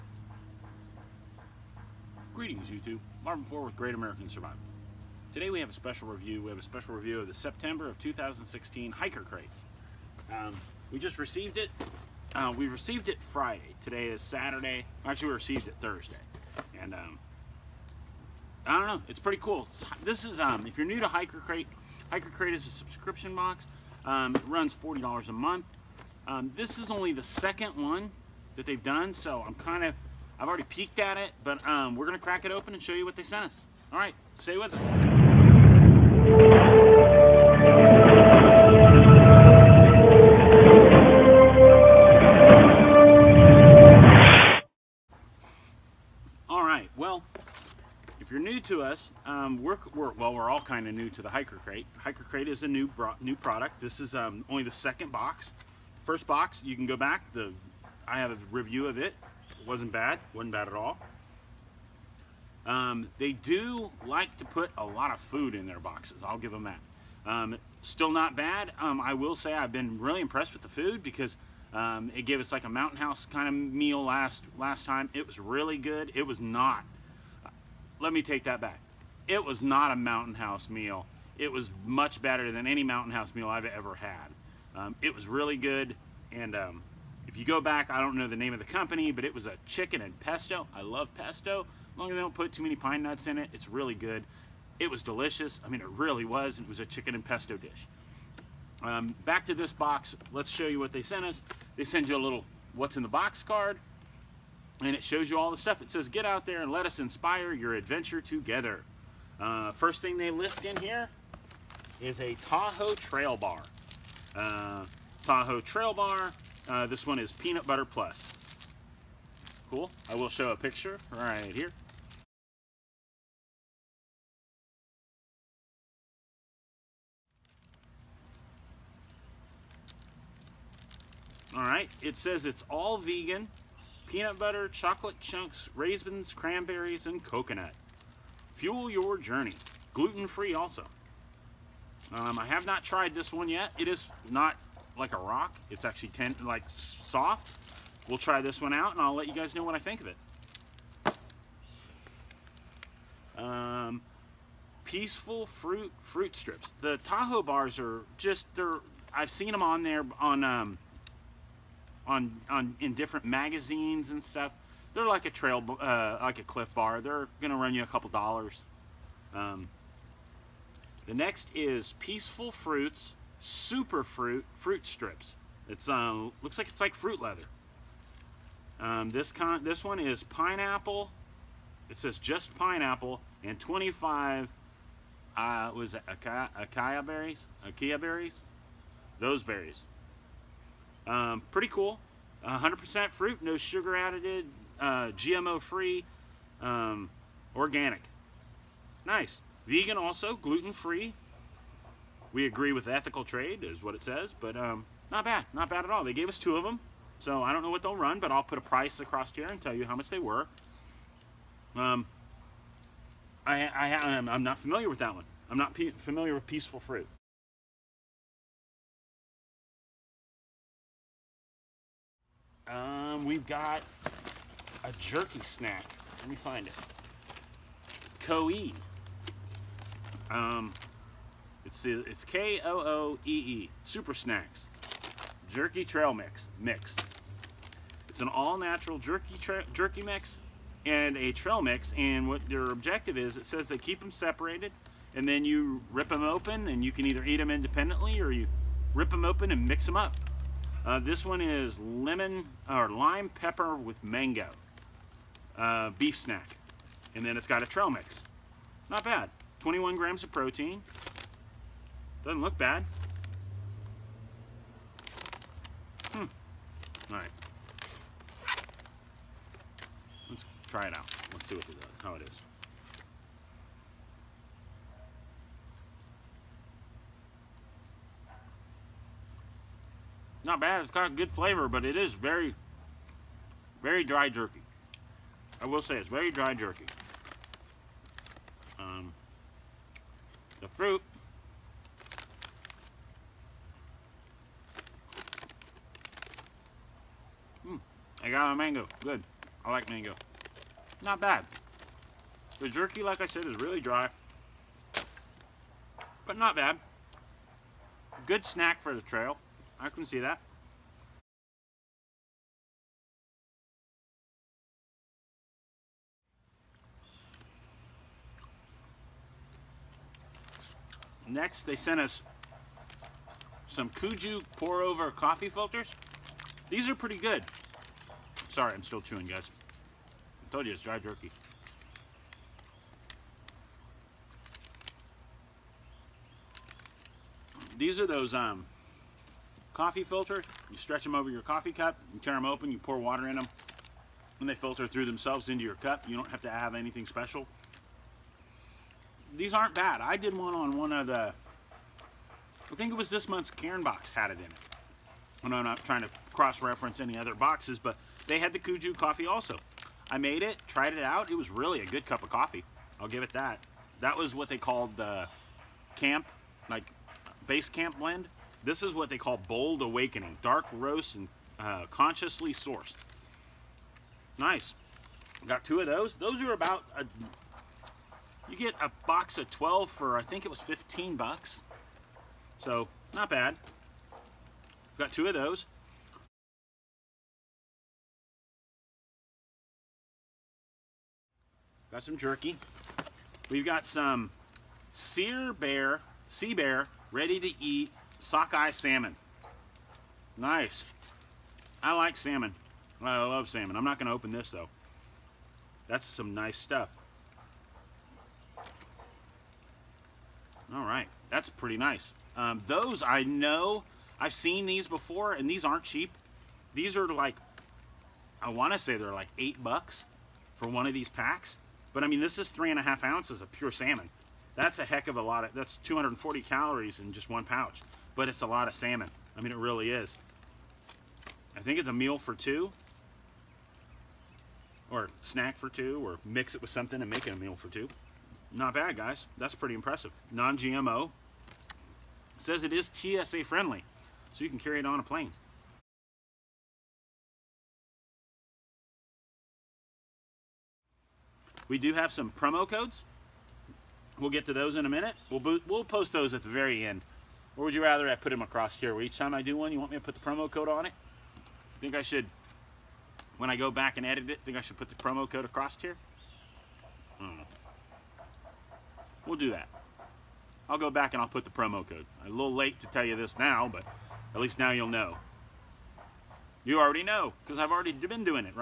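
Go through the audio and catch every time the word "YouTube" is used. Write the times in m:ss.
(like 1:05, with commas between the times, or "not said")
0:02.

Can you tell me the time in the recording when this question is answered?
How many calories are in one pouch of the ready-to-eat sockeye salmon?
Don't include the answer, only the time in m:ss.
7:05.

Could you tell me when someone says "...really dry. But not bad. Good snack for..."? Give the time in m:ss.
5:03.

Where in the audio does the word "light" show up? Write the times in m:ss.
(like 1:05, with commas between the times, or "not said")
not said.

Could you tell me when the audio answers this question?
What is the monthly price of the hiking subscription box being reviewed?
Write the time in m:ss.
0:24.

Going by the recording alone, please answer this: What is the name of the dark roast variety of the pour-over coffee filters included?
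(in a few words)
Bold Awakening.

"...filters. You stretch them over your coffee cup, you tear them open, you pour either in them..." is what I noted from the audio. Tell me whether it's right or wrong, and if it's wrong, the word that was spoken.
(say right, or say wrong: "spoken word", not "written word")
wrong: "water", not "either".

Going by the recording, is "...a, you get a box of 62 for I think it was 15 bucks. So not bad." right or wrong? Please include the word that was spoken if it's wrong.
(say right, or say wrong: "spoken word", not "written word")
wrong: "12", not "62".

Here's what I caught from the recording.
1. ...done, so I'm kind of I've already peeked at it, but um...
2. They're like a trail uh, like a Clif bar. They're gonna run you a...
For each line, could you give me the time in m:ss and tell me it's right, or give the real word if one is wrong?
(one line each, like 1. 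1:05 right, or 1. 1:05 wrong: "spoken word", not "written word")
1. 0:28 right
2. 2:44 right.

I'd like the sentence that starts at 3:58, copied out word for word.
It's an all-natural jerky jerky mix and a trail mix.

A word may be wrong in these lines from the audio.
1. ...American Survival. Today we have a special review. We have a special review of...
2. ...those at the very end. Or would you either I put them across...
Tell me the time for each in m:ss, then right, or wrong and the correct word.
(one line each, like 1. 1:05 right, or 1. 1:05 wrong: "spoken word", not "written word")
1. 0:03 right
2. 7:36 wrong: "rather", not "either".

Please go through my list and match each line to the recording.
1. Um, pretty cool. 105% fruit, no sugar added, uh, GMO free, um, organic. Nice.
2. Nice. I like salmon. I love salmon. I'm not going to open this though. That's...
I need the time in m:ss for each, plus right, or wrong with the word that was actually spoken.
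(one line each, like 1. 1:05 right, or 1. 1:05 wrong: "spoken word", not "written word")
1. 3:11 wrong: "100", not "105"
2. 6:40 right.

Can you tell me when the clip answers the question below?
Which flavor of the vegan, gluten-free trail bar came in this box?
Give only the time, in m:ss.
1:57.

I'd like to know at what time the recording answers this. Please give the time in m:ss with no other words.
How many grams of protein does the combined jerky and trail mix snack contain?
4:19.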